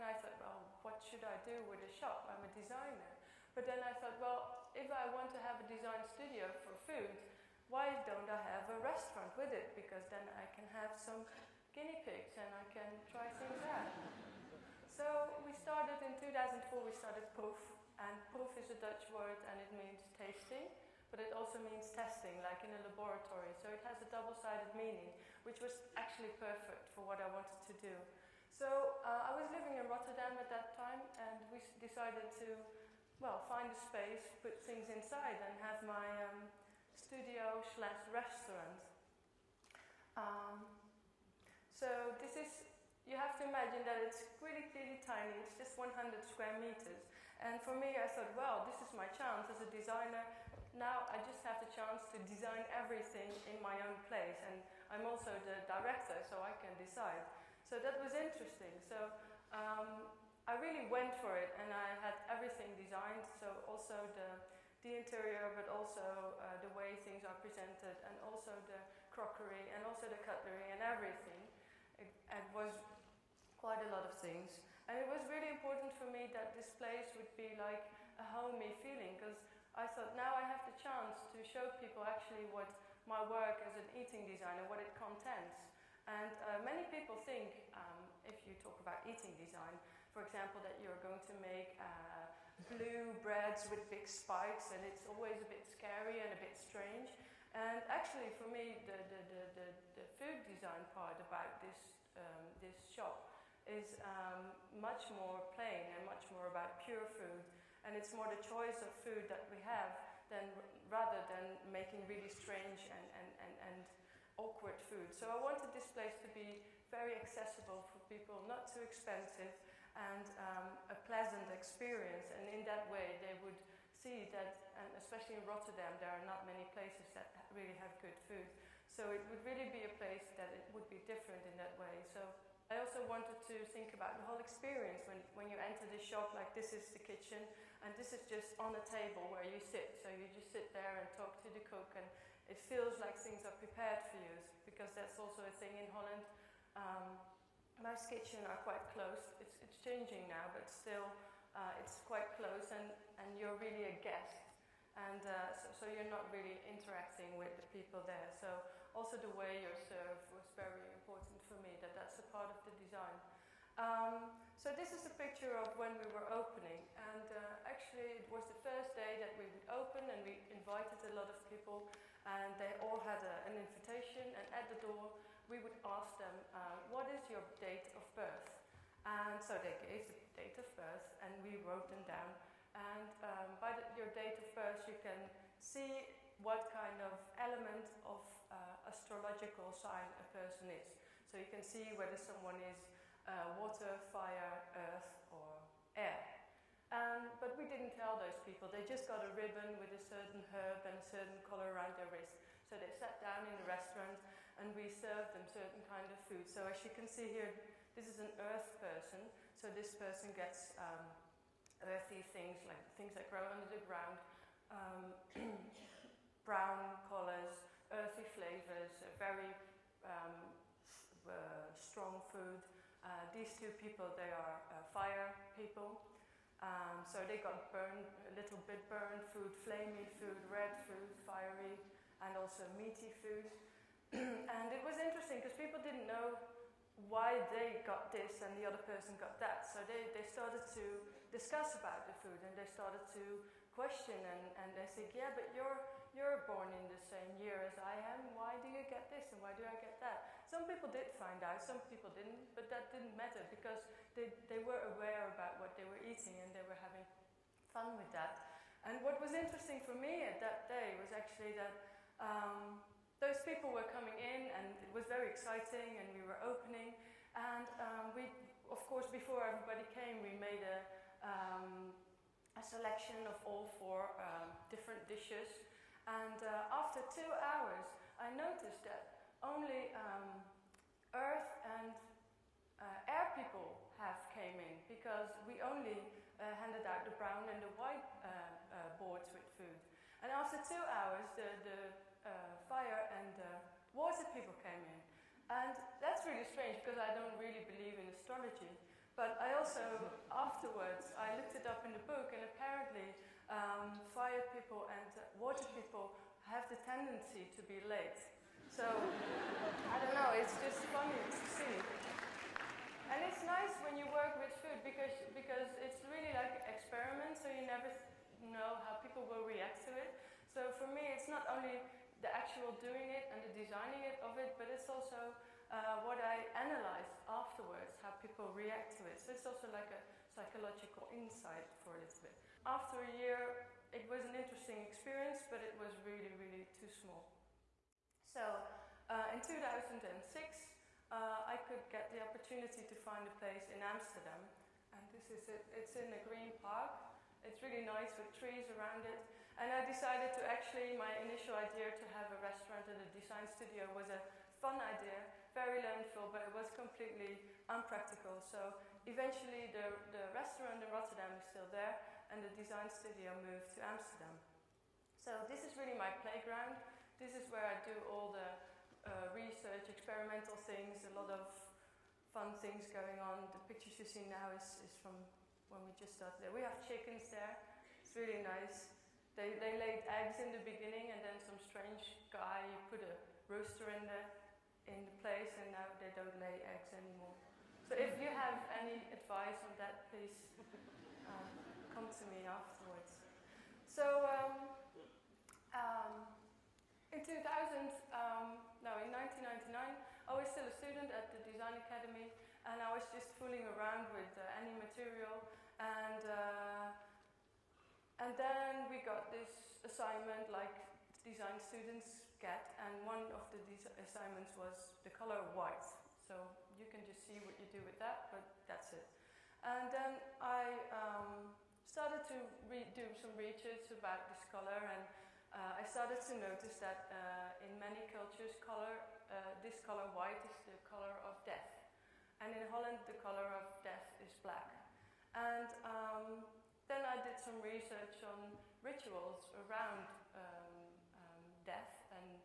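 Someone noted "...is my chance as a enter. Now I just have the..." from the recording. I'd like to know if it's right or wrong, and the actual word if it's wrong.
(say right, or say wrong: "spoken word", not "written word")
wrong: "designer", not "enter".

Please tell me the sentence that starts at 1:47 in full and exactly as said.
And it's more the choice of food that we have than, rather than making really strange and, and, and, and awkward food.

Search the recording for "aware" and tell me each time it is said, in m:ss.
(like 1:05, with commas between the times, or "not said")
4:14.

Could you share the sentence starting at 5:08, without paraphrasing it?
So, I don't know, it's just funny to see.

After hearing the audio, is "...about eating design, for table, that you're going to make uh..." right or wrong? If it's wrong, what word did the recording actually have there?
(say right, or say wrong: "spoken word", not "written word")
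wrong: "example", not "table".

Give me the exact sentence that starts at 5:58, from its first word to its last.
So eventually, the, the restaurant in Rotterdam is still there, and the design studio moved to Amsterdam.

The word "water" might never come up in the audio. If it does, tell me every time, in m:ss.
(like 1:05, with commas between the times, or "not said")
3:13, 4:53, 5:05.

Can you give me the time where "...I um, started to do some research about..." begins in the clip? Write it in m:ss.
7:00.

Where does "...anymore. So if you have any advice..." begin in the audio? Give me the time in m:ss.
6:26.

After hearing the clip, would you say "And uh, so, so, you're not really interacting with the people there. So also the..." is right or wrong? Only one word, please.
right.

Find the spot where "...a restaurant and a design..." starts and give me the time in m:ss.
5:52.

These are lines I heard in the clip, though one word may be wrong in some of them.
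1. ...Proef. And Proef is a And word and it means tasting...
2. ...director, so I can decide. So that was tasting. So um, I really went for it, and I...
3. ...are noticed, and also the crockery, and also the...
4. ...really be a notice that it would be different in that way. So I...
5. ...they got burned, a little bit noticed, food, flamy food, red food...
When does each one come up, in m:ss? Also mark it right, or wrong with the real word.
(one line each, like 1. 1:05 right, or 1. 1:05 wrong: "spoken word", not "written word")
1. 0:17 wrong: "Dutch", not "And"
2. 0:55 wrong: "interesting", not "tasting"
3. 1:07 wrong: "presented", not "noticed"
4. 2:09 wrong: "place", not "notice"
5. 3:47 wrong: "burned", not "noticed".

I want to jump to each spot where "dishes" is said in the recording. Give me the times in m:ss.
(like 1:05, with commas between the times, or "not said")
4:35.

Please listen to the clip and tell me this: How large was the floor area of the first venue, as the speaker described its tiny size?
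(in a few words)
100 square meters.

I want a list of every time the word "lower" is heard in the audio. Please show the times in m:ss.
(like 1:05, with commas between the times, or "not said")
not said.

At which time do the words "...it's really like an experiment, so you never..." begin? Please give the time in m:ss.
5:15.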